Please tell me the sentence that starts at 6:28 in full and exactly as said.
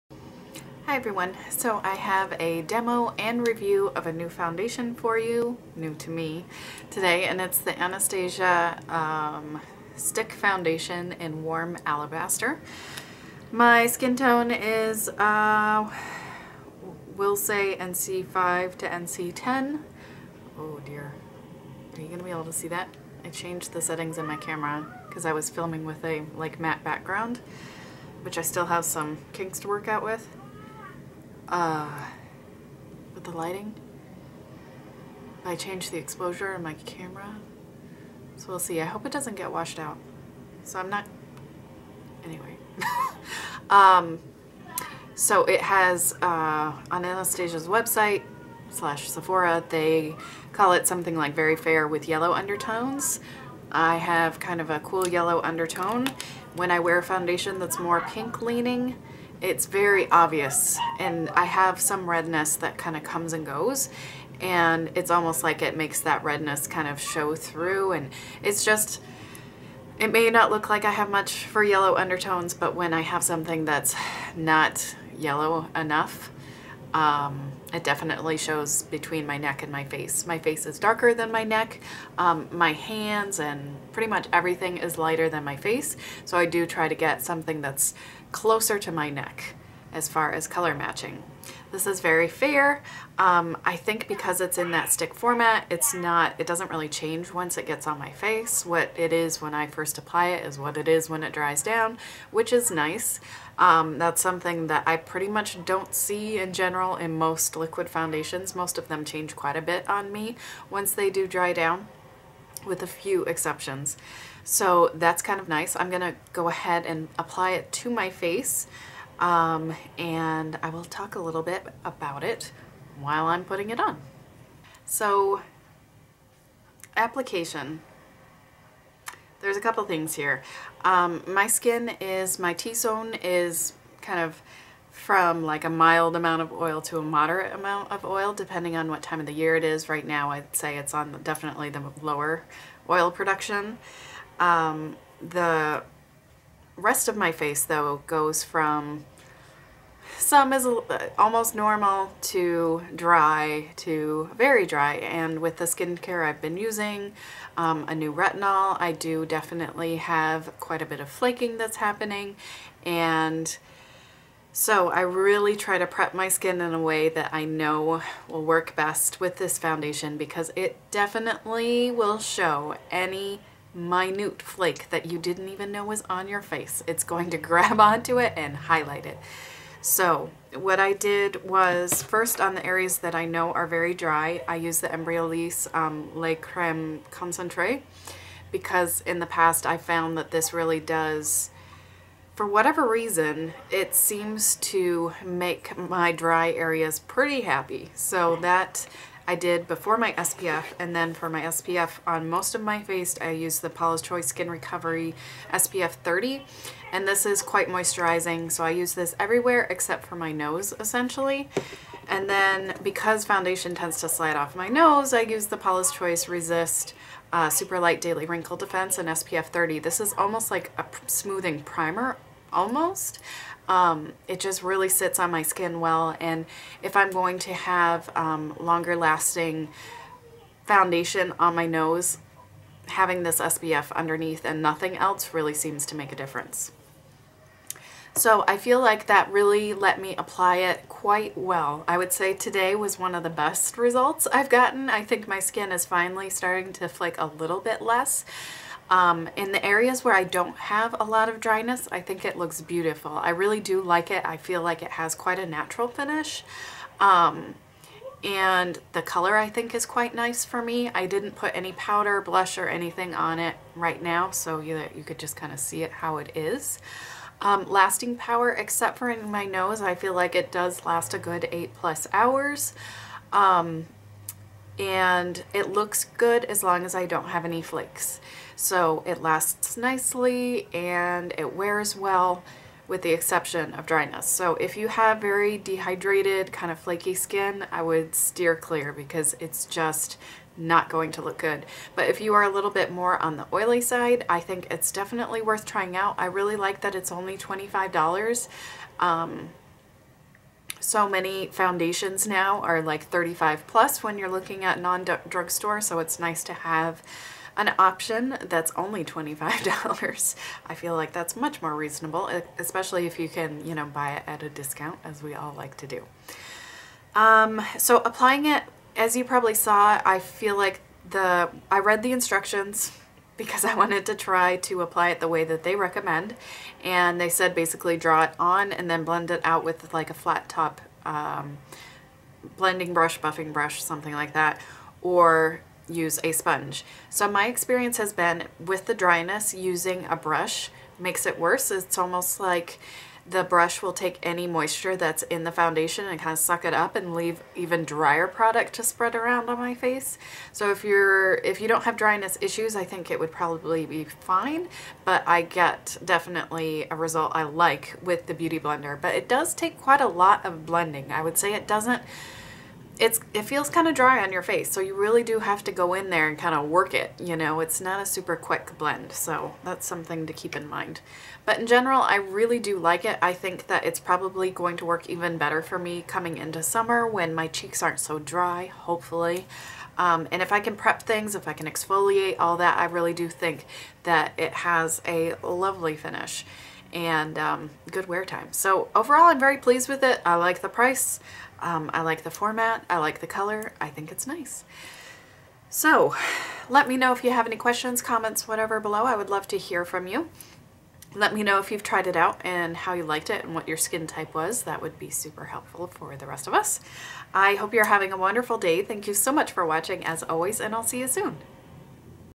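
So overall, I'm very pleased with it.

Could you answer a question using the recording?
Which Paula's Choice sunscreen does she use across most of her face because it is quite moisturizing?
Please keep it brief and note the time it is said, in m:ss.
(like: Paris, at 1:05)
Skin Recovery SPF 30, at 3:24.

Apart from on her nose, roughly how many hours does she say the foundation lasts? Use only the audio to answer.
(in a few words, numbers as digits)
8 plus hours.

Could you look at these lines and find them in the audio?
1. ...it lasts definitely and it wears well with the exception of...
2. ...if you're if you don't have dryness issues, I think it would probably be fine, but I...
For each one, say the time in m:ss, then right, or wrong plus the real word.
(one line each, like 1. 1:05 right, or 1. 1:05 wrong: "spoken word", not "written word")
1. 4:39 wrong: "nicely", not "definitely"
2. 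5:50 right.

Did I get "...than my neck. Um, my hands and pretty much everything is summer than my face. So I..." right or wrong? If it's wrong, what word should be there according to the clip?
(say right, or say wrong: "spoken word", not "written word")
wrong: "lighter", not "summer".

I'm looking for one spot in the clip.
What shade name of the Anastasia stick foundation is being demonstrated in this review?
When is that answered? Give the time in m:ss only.
0:11.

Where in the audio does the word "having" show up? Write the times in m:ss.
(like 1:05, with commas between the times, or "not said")
3:52, 6:47.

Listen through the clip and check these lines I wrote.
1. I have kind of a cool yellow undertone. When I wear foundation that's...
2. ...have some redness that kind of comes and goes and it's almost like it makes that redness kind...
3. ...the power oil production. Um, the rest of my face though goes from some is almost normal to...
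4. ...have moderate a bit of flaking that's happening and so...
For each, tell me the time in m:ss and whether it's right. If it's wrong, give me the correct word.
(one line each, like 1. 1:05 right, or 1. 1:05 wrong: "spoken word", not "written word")
1. 0:53 right
2. 1:01 right
3. 2:21 wrong: "lower", not "power"
4. 2:39 wrong: "quite", not "moderate".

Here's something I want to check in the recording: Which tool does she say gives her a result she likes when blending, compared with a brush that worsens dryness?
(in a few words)
Beauty Blender.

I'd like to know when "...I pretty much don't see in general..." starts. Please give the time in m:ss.
1:44.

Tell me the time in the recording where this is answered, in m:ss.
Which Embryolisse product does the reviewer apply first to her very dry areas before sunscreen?
3:06.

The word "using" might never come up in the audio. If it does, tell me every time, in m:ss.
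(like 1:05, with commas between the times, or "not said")
2:36, 5:39.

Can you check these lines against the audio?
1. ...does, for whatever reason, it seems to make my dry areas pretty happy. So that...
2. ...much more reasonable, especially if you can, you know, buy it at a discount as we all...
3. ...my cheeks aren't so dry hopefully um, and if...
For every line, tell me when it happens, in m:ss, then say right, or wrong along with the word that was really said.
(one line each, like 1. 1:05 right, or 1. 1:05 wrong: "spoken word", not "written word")
1. 3:10 right
2. 5:11 right
3. 6:17 right.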